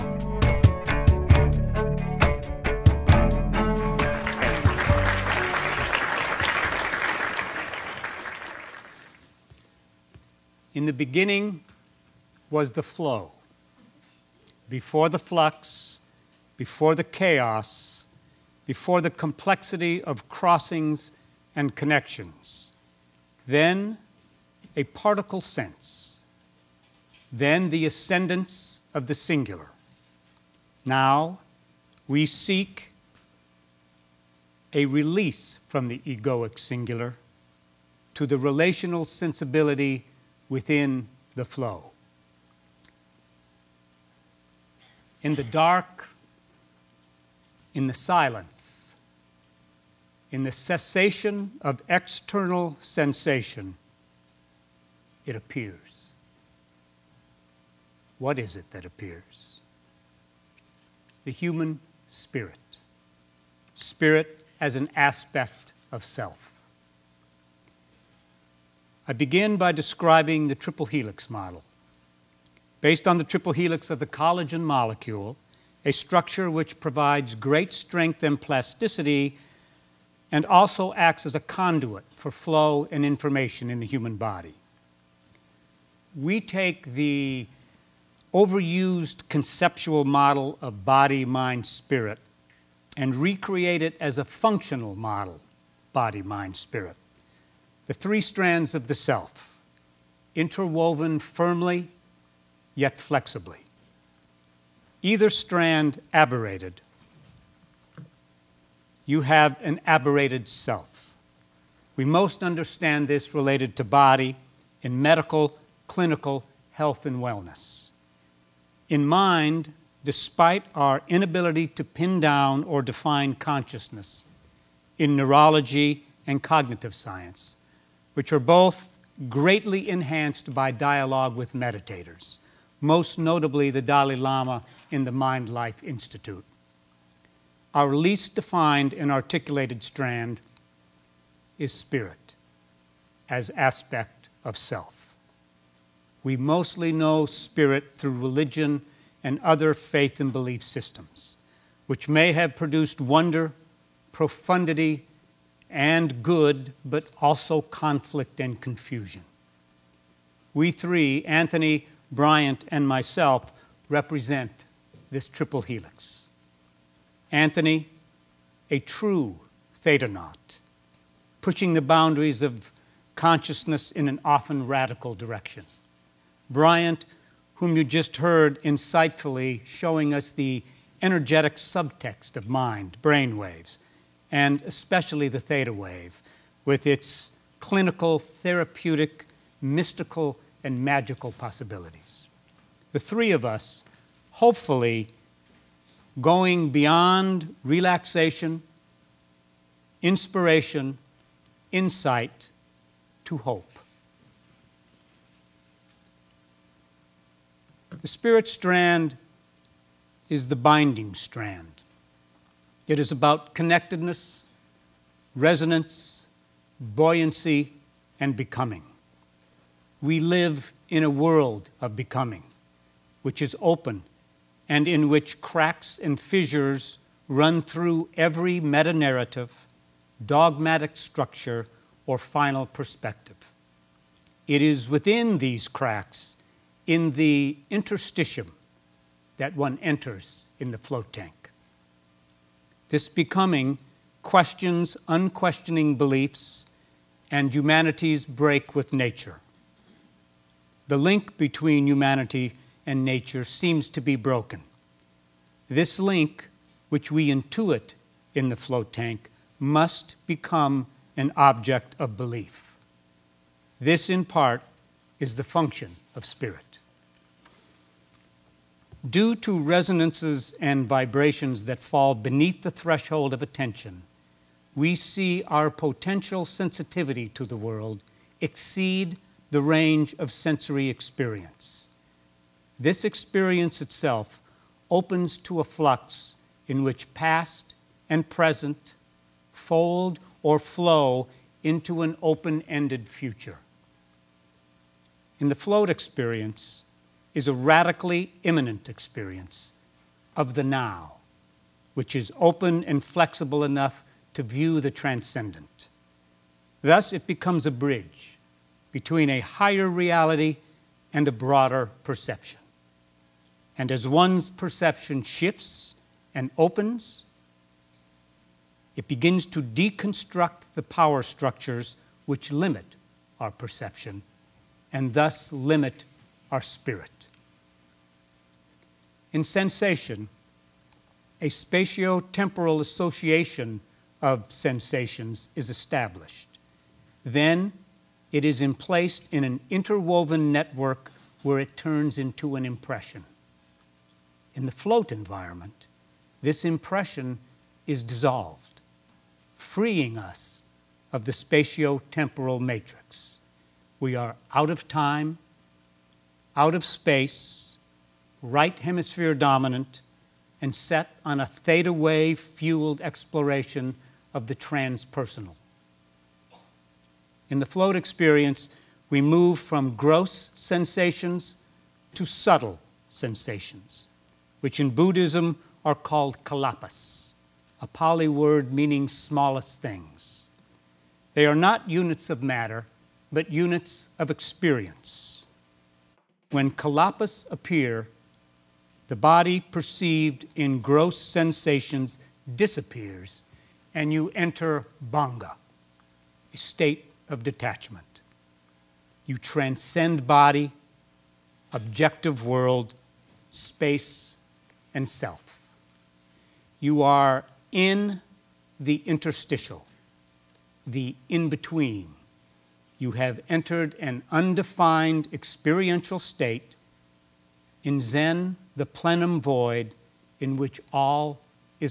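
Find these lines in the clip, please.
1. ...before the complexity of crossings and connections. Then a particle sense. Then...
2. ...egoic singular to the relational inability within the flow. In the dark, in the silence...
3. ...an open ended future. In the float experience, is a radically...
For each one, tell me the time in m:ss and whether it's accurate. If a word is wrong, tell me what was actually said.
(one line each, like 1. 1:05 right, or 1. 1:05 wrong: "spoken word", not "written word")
1. 0:18 right
2. 0:35 wrong: "sensibility", not "inability"
3. 4:52 right.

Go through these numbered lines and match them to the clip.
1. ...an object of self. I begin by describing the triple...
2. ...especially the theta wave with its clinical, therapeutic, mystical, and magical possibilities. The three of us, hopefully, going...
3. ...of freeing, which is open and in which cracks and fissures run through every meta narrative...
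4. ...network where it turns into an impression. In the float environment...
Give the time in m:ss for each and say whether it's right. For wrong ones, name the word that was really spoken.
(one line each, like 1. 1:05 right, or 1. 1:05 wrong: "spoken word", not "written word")
1. 1:04 wrong: "aspect", not "object"
2. 3:04 right
3. 3:41 wrong: "becoming", not "freeing"
4. 5:40 right.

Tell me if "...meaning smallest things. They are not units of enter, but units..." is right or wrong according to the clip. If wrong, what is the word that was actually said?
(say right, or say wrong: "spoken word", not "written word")
wrong: "matter", not "enter".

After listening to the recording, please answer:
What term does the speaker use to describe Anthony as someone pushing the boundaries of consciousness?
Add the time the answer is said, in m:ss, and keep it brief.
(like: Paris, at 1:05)
thetanaut, at 2:49.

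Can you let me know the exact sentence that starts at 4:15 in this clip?
This link, which we intuit in the float tank, must become an object of belief.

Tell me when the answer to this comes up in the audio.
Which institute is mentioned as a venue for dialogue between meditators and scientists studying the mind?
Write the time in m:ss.
2:15.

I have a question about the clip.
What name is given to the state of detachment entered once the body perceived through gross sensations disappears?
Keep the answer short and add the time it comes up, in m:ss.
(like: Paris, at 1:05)
bhanga, at 6:35.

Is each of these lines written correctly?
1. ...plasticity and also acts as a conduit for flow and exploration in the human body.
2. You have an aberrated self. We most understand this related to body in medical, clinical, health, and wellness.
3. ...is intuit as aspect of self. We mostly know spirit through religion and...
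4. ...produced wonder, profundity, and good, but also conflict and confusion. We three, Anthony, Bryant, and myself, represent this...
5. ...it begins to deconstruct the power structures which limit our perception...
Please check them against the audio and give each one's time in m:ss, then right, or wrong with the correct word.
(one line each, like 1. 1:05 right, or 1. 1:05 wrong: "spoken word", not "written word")
1. 1:18 wrong: "information", not "exploration"
2. 1:49 right
3. 2:21 wrong: "spirit", not "intuit"
4. 2:32 right
5. 5:18 right.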